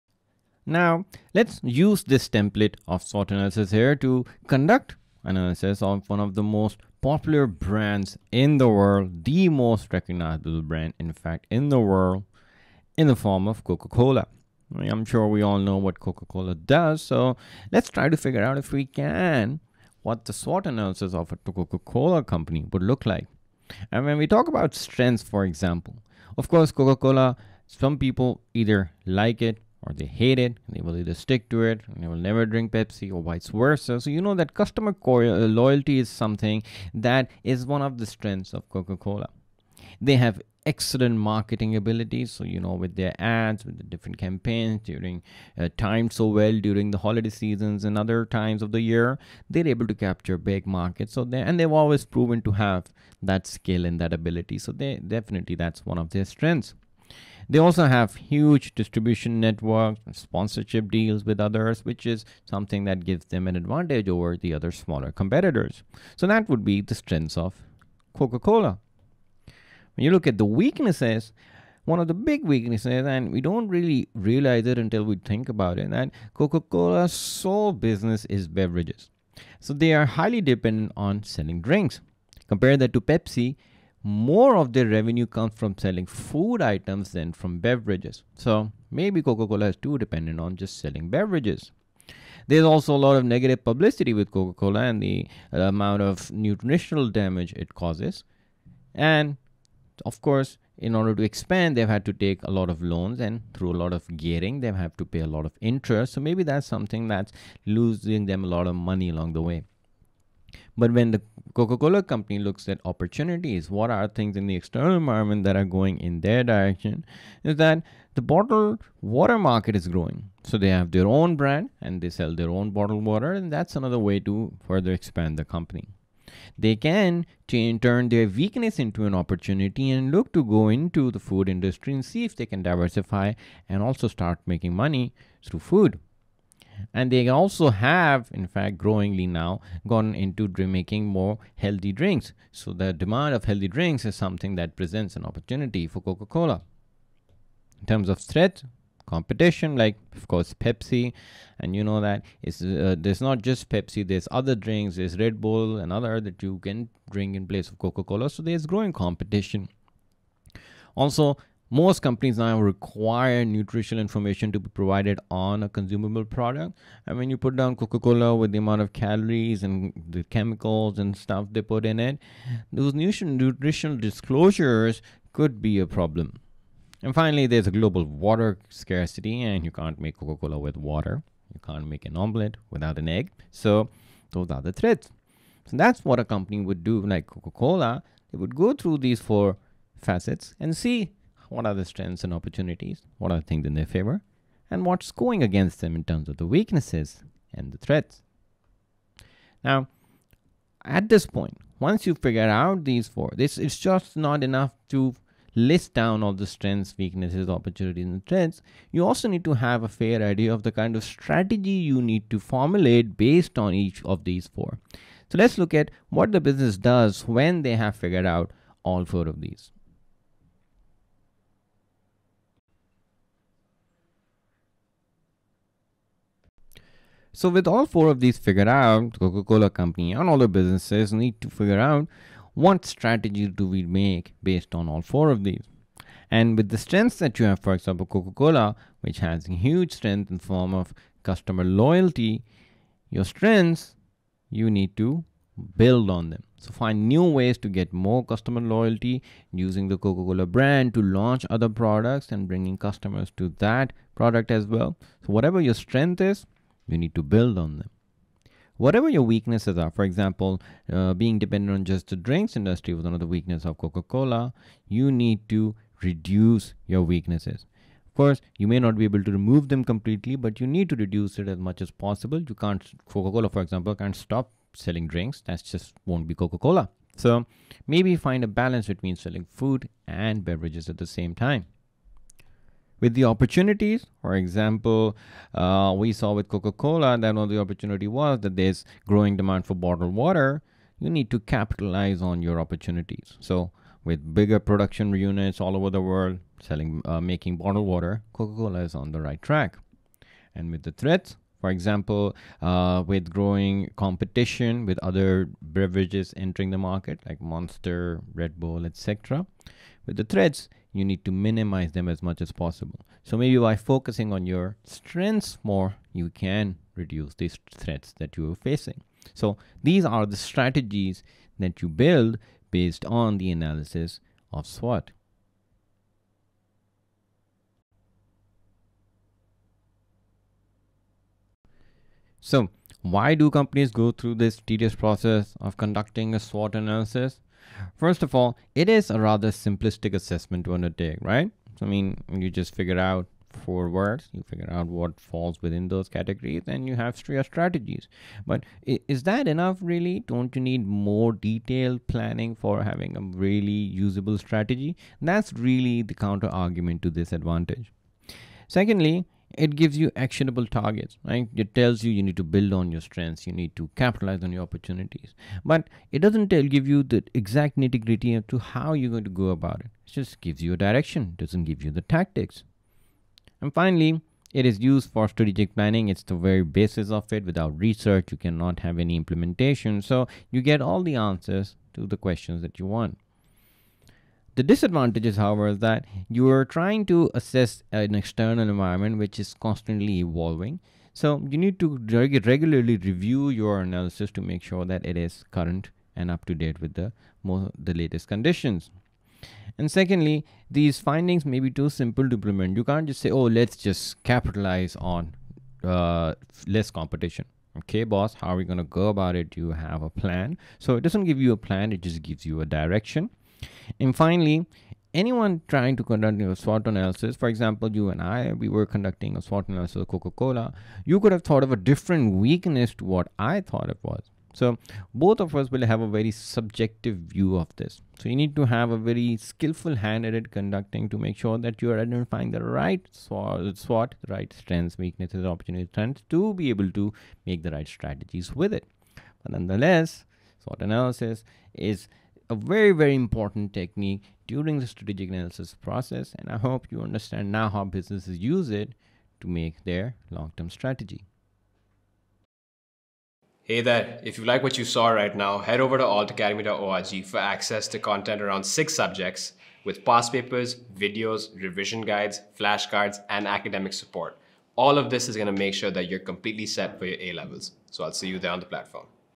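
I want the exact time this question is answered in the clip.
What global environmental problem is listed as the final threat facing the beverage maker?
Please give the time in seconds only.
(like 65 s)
177 s.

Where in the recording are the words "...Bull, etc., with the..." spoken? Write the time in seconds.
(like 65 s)
308 s.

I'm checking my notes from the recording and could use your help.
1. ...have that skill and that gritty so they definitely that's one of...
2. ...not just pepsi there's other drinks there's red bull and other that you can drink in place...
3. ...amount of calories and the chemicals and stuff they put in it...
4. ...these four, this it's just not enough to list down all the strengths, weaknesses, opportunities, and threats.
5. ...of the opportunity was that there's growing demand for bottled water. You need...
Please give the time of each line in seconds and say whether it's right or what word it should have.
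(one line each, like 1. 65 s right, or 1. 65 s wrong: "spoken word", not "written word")
1. 52 s wrong: "ability", not "gritty"
2. 153 s right
3. 168 s right
4. 202 s right
5. 287 s right.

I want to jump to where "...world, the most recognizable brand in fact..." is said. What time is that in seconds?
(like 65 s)
8 s.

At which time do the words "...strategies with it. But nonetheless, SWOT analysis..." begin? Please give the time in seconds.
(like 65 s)
437 s.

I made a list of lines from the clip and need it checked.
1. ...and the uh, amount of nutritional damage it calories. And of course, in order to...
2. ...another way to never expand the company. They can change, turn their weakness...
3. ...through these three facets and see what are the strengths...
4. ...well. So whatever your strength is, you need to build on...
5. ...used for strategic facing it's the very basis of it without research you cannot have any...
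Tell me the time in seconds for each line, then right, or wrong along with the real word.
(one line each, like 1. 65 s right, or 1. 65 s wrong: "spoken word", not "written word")
1. 94 s wrong: "causes", not "calories"
2. 123 s wrong: "further", not "never"
3. 188 s wrong: "four", not "three"
4. 254 s right
5. 374 s wrong: "planning", not "facing".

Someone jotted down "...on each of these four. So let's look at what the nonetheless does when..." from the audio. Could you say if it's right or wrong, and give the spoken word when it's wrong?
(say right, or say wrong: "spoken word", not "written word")
wrong: "business", not "nonetheless".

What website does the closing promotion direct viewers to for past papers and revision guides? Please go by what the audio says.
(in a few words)
altacademy.org.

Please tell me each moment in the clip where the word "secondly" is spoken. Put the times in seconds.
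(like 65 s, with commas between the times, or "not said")
358 s, 399 s.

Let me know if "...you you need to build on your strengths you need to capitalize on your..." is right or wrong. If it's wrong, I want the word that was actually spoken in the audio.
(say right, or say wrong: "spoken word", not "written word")
right.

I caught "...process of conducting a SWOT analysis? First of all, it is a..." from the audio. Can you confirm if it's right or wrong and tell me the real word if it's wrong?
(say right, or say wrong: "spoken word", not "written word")
right.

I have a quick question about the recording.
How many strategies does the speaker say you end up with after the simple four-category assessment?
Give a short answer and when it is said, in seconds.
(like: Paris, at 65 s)
3, at 347 s.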